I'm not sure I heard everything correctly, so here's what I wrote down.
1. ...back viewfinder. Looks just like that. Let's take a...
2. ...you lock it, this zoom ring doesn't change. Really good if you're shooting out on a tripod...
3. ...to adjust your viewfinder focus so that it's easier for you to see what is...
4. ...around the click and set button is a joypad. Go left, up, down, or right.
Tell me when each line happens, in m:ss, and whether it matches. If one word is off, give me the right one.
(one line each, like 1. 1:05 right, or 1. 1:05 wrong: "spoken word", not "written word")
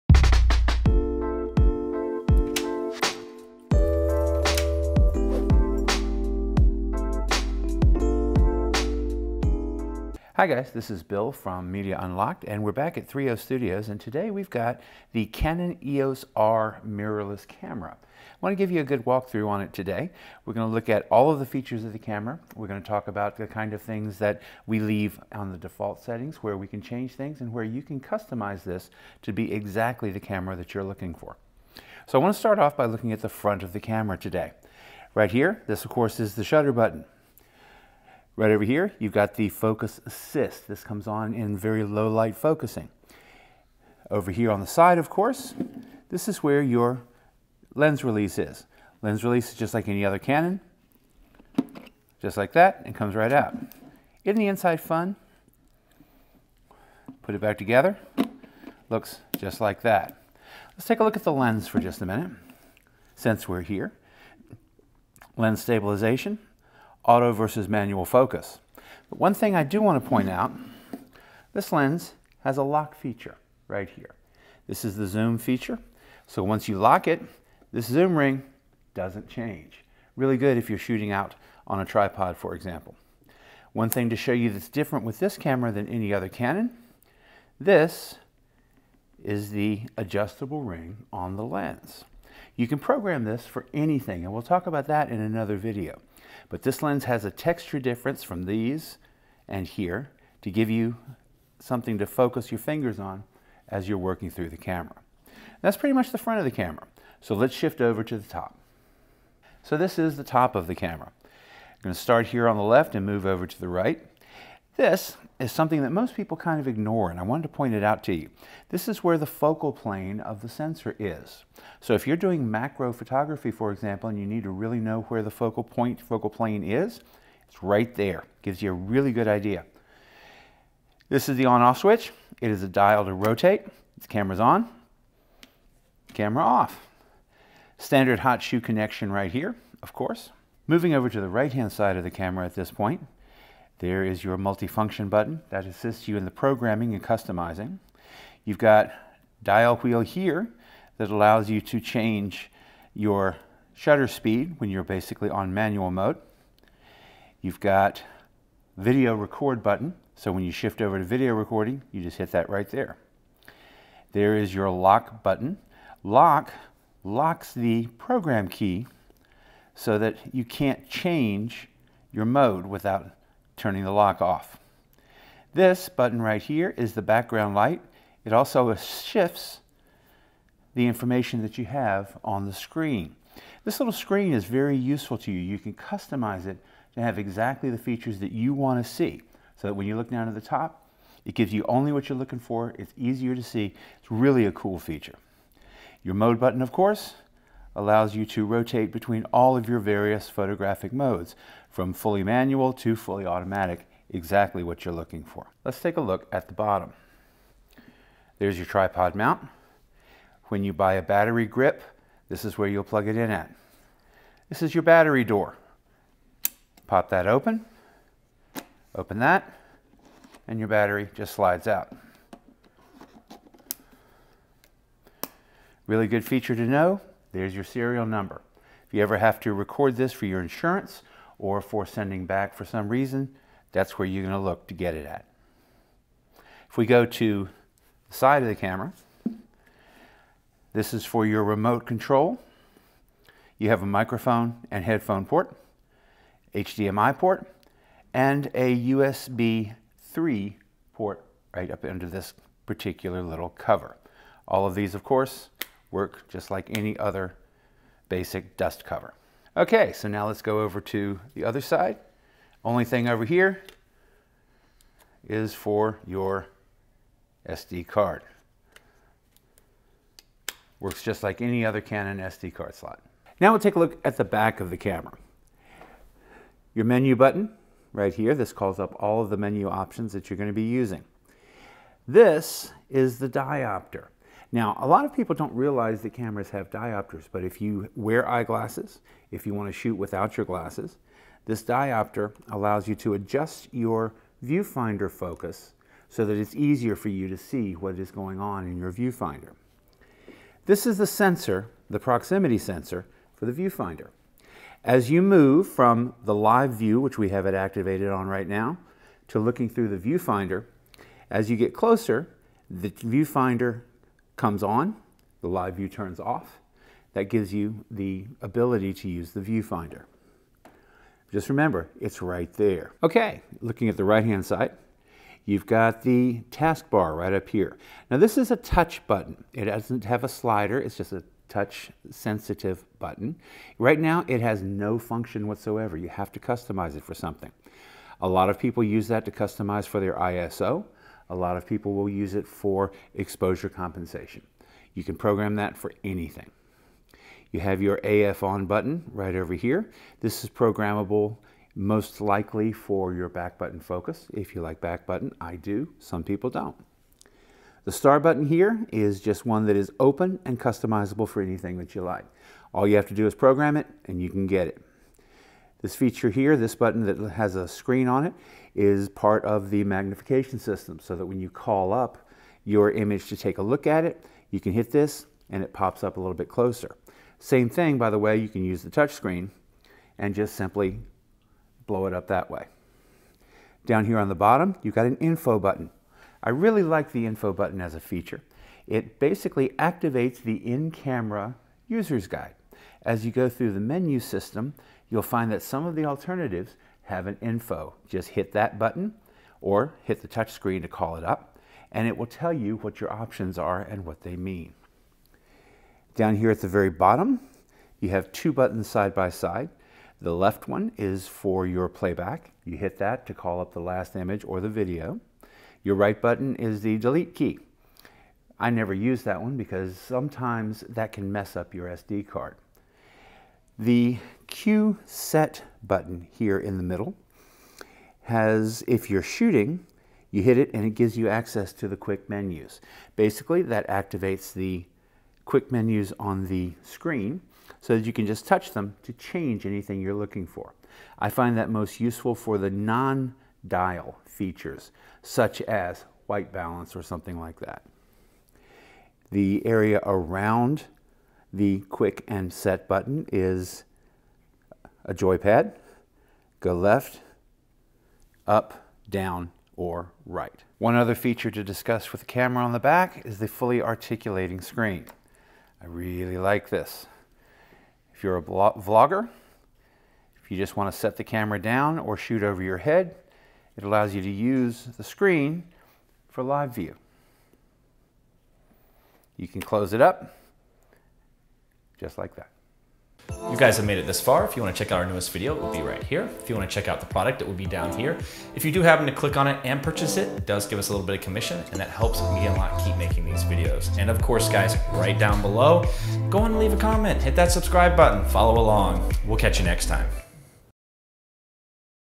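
1. 0:57 wrong: "together", not "viewfinder"
2. 1:16 right
3. 4:52 right
4. 7:30 wrong: "quick", not "click".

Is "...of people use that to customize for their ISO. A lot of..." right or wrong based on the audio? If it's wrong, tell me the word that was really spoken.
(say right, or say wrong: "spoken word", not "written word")
right.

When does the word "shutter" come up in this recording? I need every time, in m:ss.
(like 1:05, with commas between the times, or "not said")
0:36, 2:33.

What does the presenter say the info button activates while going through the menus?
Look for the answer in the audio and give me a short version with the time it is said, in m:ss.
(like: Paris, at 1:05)
In-camera user's guide, at 6:30.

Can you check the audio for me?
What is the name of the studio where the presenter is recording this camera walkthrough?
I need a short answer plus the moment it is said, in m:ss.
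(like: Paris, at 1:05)
3O Studios, at 0:13.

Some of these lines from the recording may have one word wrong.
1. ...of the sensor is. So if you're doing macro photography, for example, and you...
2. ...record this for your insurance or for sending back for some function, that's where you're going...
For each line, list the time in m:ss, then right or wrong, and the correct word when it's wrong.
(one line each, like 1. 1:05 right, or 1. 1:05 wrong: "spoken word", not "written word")
1. 2:00 right
2. 3:49 wrong: "reason", not "function".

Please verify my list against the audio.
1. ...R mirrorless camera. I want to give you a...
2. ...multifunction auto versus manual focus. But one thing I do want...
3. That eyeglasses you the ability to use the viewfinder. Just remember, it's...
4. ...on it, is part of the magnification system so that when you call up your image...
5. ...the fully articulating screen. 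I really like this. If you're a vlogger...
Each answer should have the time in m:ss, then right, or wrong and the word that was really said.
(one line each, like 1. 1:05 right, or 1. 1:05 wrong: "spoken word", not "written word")
1. 0:16 right
2. 1:05 wrong: "stabilization", not "multifunction"
3. 5:17 wrong: "gives", not "eyeglasses"
4. 6:08 right
5. 7:43 right.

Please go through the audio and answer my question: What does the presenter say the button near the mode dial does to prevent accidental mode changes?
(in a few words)
Locks the program key.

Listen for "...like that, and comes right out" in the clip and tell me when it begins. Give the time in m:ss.
0:52.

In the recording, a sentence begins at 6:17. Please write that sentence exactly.
Same thing, by the way, you can use the touch screen and just simply blow it up that way.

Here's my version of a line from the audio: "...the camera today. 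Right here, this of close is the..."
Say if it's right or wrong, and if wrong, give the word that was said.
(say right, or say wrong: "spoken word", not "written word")
wrong: "course", not "close".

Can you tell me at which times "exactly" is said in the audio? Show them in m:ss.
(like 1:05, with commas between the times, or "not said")
0:29, 3:07, 3:24.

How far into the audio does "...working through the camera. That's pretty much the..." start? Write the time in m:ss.
1:43.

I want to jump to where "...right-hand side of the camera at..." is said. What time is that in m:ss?
2:21.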